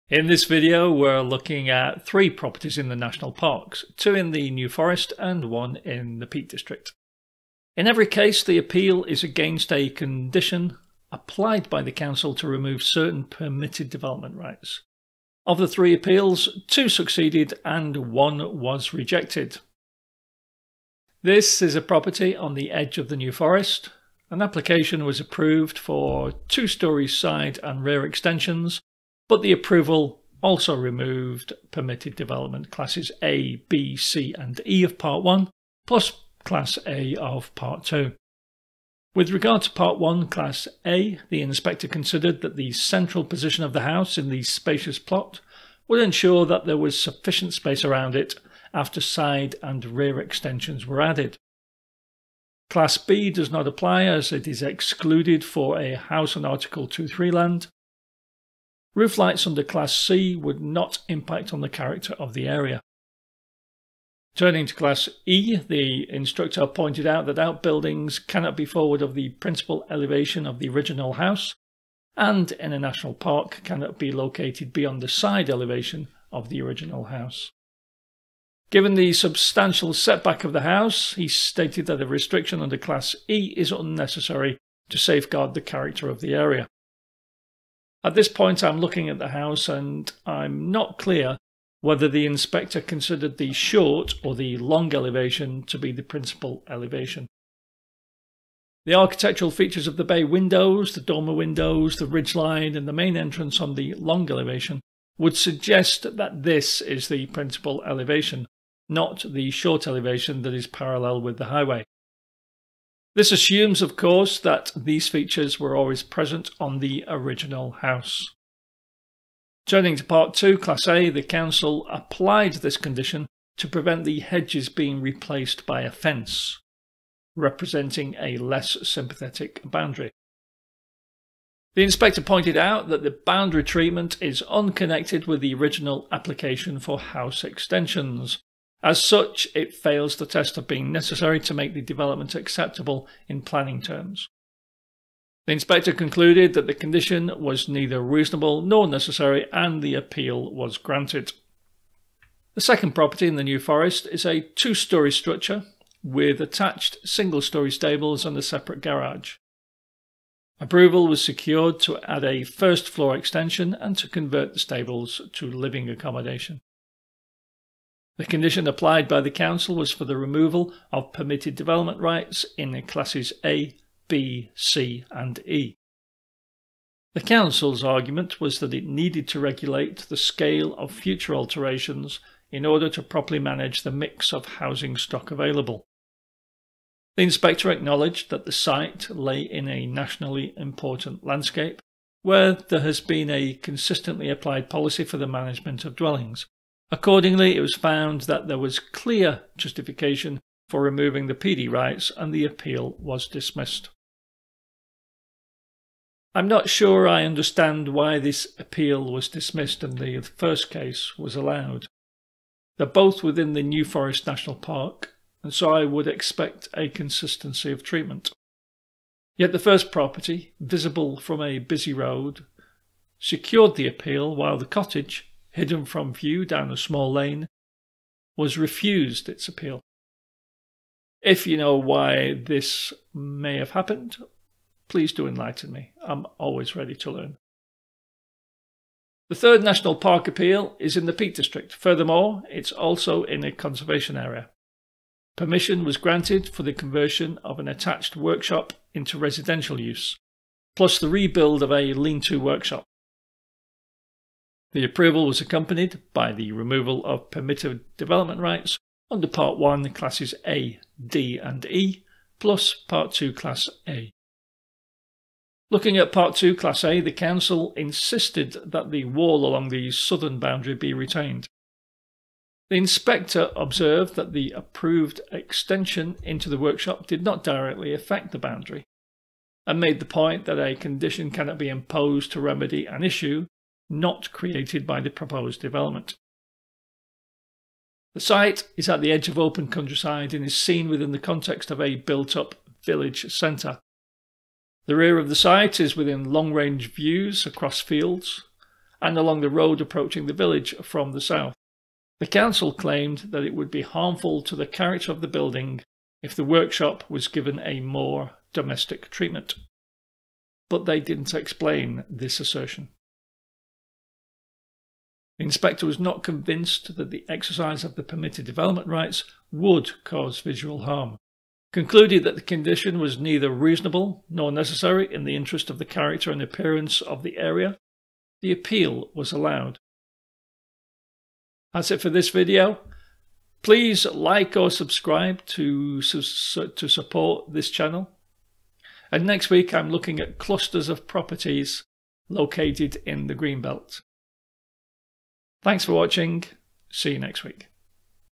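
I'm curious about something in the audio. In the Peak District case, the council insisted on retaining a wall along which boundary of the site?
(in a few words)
Southern boundary.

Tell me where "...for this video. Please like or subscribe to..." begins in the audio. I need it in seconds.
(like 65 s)
332 s.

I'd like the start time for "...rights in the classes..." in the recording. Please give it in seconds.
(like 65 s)
171 s.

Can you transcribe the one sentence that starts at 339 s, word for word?
And next week I'm looking at clusters of properties located in the Greenbelt.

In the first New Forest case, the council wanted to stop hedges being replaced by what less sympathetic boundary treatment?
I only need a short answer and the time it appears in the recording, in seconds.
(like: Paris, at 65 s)
A fence, at 125 s.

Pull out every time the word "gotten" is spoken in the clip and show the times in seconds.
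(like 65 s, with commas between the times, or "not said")
not said.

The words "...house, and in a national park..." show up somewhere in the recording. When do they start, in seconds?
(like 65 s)
71 s.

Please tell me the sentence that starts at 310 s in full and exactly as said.
But they didn't explain this assertion.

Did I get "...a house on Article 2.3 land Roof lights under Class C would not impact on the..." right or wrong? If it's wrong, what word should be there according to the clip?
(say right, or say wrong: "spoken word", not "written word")
right.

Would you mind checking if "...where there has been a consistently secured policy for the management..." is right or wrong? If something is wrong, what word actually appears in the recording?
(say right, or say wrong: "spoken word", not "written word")
wrong: "applied", not "secured".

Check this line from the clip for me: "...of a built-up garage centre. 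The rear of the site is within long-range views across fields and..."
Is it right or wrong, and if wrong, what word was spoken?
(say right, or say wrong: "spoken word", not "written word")
wrong: "village", not "garage".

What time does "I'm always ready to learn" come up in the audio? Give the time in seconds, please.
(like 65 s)
236 s.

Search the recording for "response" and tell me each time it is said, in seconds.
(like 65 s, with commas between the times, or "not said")
not said.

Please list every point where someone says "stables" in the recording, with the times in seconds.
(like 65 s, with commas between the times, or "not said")
157 s, 164 s.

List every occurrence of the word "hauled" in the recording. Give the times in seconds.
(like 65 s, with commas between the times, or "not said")
not said.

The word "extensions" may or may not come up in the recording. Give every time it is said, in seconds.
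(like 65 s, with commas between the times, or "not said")
28 s, 50 s, 137 s, 163 s, 275 s.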